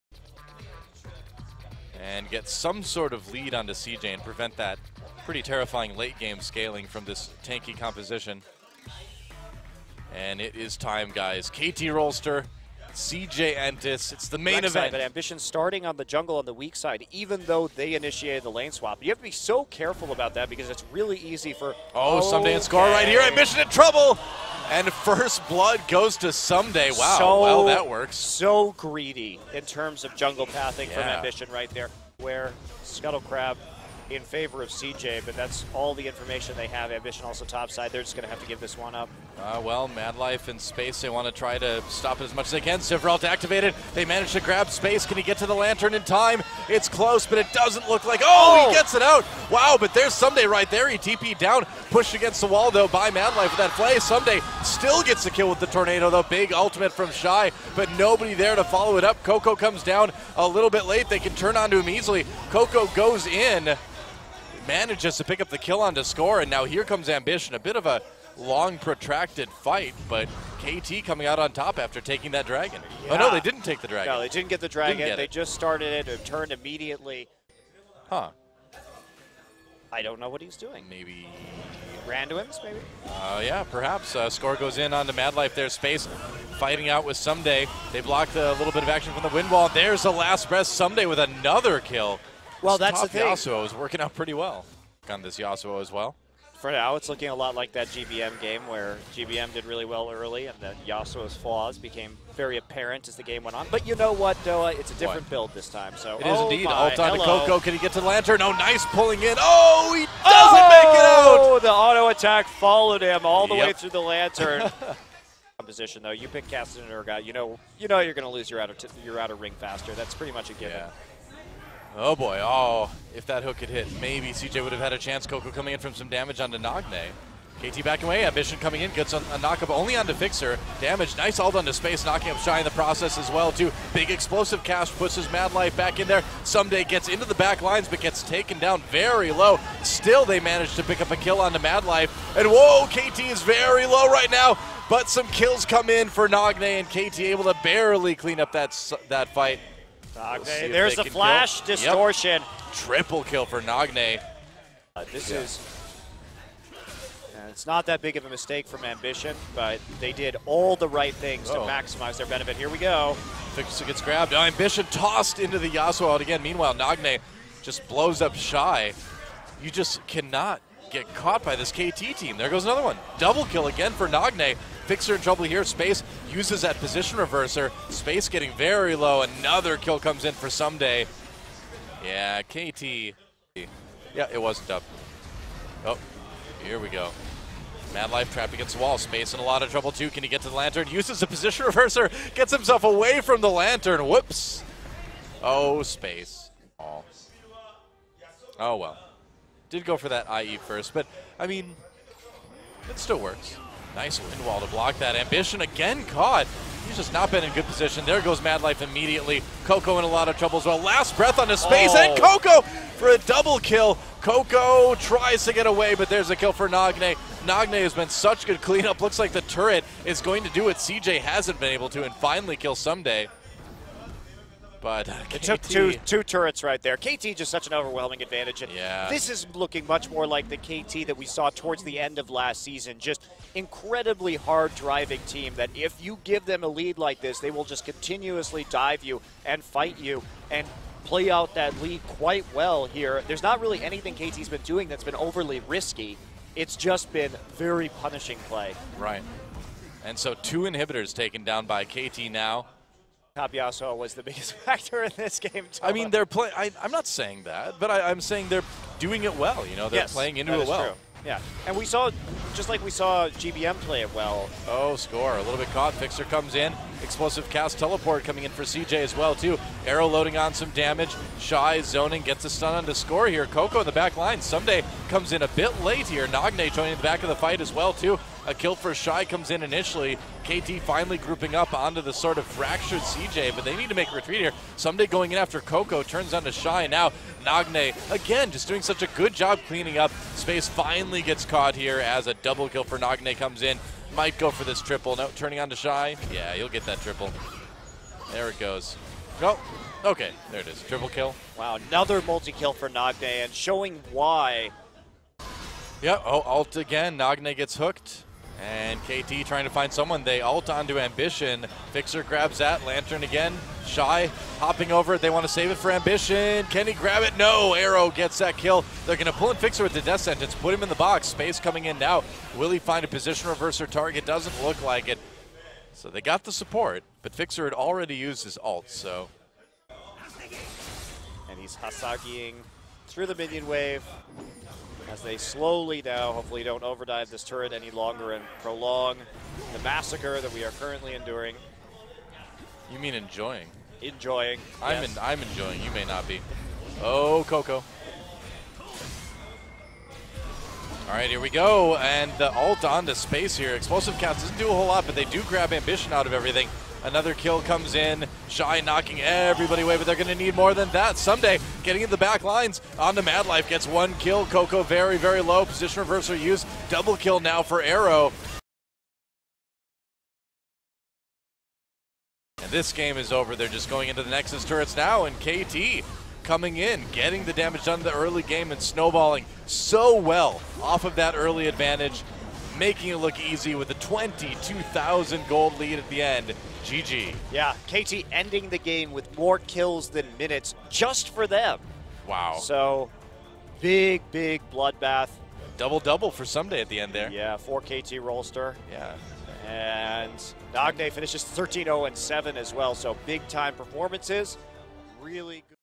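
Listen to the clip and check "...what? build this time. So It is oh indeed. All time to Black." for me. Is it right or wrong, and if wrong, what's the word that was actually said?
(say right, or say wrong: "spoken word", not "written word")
wrong: "Coco", not "Black".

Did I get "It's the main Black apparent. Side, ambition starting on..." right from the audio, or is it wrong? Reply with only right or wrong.
wrong.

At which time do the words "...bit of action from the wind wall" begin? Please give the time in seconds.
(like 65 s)
88 s.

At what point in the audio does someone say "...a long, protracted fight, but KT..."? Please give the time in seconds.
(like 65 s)
67 s.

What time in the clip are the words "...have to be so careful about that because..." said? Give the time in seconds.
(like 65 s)
19 s.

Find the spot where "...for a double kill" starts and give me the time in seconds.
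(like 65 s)
212 s.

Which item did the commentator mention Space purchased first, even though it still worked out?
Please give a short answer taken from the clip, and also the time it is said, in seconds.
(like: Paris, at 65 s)
IE, at 200 s.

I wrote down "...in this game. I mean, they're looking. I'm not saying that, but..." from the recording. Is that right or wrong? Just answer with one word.
wrong.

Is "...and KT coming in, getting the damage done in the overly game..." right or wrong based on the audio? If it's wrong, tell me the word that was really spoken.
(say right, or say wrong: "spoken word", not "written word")
wrong: "early", not "overly".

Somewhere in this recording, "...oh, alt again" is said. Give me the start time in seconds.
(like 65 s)
306 s.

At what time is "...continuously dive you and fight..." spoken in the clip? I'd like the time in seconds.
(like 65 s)
237 s.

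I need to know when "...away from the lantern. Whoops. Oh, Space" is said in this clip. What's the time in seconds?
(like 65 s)
192 s.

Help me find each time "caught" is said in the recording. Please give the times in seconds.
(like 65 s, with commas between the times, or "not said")
171 s, 206 s, 265 s, 291 s.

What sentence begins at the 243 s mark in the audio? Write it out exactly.
There's not really anything KT's been doing that's been overly risky.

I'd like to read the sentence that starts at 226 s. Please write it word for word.
KT just such an overwhelming advantage.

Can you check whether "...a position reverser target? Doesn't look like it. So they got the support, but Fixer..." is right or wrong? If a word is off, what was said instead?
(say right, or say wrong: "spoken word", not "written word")
right.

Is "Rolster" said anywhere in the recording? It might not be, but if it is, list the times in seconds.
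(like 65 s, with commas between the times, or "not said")
11 s, 398 s.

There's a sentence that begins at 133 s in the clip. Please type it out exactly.
Big explosive cask pushes Mad Life back in there.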